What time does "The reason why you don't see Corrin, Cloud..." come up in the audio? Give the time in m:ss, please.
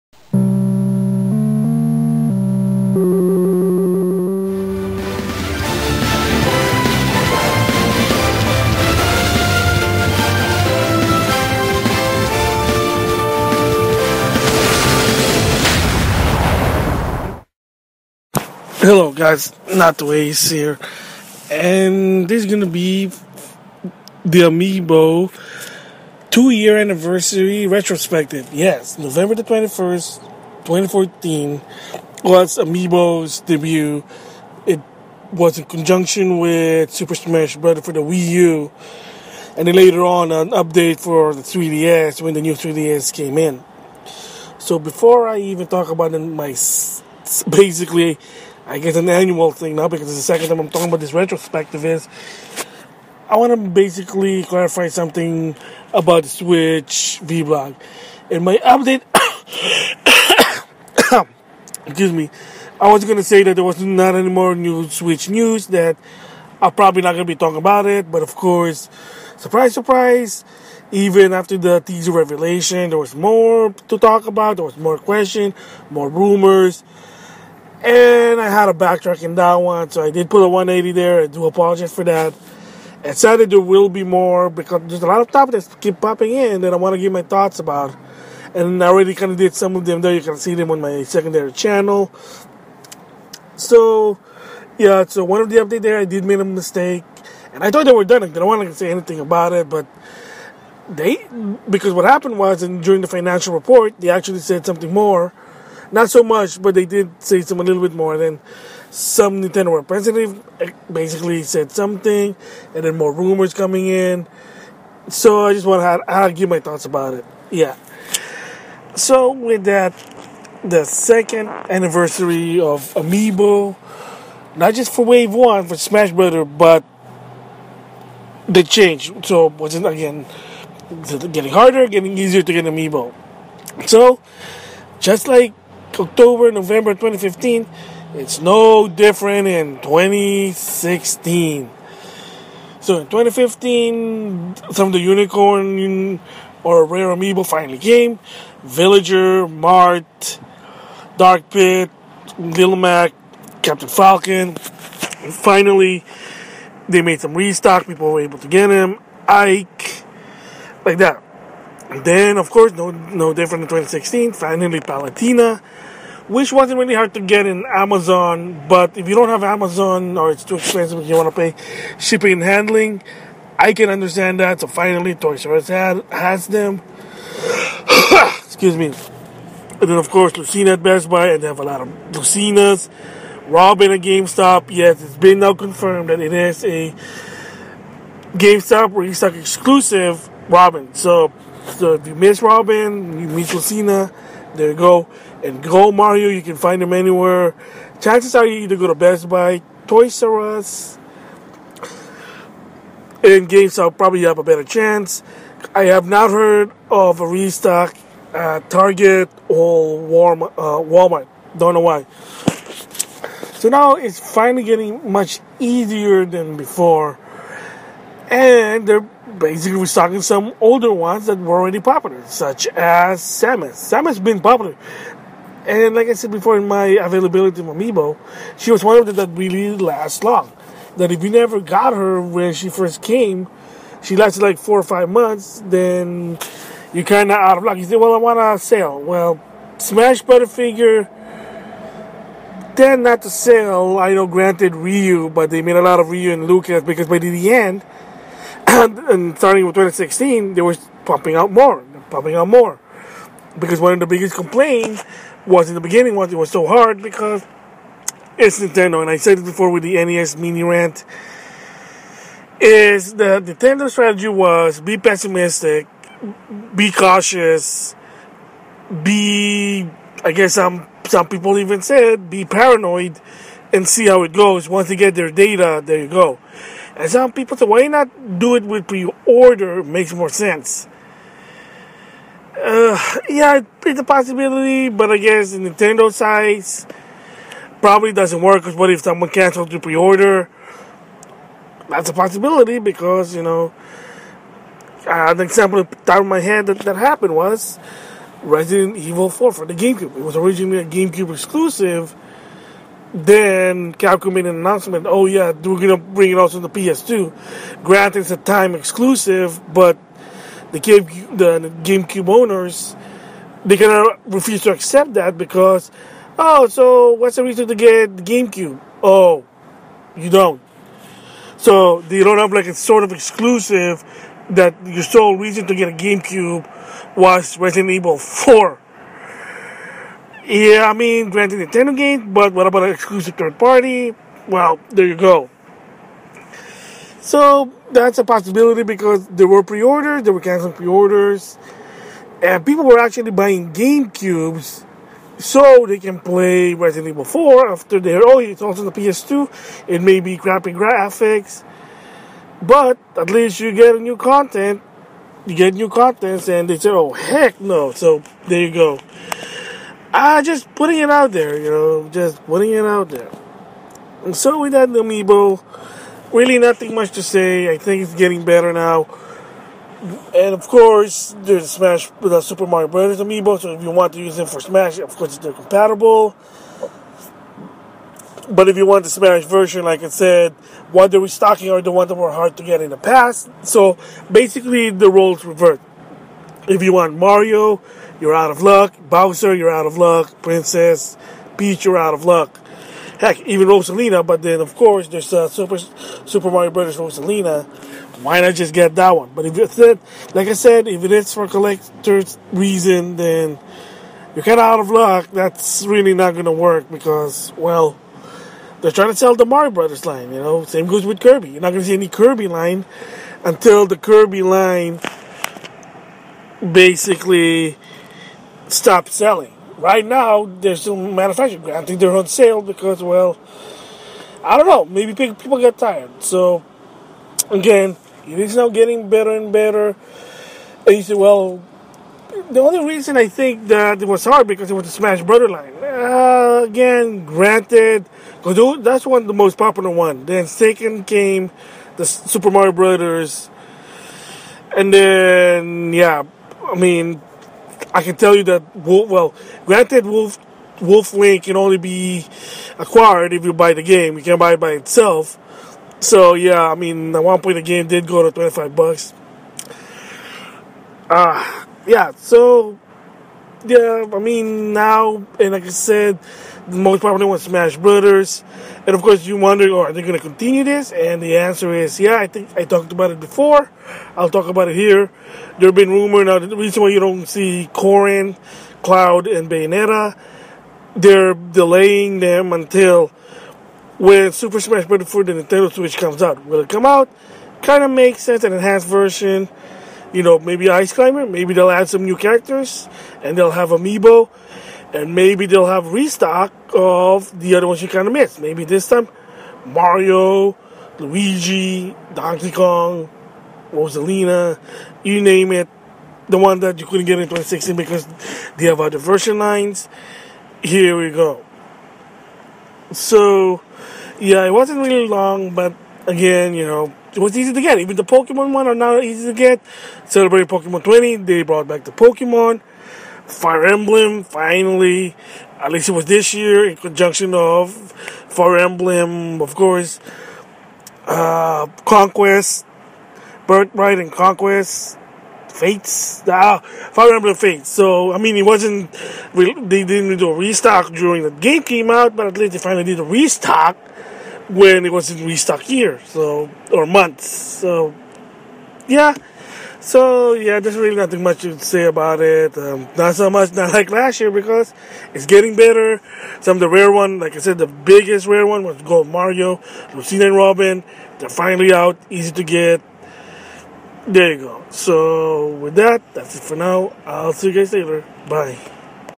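7:56.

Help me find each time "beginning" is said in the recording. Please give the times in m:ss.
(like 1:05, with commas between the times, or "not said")
4:15.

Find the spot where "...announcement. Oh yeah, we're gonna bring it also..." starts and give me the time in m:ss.
5:04.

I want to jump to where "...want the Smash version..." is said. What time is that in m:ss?
6:18.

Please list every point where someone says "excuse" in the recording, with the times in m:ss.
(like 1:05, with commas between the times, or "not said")
1:01, 2:58.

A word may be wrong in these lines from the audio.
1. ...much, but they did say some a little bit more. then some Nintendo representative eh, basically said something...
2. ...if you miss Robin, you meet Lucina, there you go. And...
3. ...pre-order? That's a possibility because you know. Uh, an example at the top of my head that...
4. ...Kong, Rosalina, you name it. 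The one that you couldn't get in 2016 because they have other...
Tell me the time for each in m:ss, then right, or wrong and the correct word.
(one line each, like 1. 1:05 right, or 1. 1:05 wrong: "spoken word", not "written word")
1. 1:46 right
2. 3:11 right
3. 4:49 right
4. 8:22 right.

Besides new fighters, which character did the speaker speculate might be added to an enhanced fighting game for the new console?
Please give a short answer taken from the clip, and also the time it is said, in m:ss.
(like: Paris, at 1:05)
Ice Climber, at 8:10.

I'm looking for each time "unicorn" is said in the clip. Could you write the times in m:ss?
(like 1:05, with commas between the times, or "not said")
2:24.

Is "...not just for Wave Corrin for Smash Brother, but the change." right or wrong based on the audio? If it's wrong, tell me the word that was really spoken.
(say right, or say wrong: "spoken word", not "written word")
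wrong: "One", not "Corrin".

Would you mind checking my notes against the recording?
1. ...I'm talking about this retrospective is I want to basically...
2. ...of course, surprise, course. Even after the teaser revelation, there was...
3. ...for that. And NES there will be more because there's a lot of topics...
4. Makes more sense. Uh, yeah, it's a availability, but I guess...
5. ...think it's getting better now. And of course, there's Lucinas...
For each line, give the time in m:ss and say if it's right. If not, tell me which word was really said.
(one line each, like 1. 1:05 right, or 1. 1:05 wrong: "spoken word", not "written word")
1. 0:50 right
2. 1:08 wrong: "surprise", not "course"
3. 1:21 wrong: "Saturday", not "NES"
4. 4:39 wrong: "possibility", not "availability"
5. 6:07 wrong: "Smash", not "Lucinas".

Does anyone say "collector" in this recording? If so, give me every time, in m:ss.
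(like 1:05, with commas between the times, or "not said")
6:41.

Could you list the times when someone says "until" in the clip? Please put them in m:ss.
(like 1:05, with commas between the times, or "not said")
6:53, 8:02.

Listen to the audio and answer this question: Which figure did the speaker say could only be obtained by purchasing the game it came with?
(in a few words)
Wolf Link.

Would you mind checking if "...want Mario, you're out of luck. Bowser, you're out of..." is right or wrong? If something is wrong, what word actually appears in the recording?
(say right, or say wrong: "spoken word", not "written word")
right.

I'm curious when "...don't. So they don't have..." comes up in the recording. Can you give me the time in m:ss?
5:20.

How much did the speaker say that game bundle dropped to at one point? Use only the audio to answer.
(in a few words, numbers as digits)
$25.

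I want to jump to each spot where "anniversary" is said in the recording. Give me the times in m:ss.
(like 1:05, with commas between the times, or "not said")
0:26, 2:01.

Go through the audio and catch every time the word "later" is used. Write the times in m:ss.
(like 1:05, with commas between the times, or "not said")
0:39, 9:27.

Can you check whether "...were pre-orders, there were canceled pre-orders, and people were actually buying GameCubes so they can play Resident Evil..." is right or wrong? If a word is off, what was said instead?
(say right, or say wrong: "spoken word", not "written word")
right.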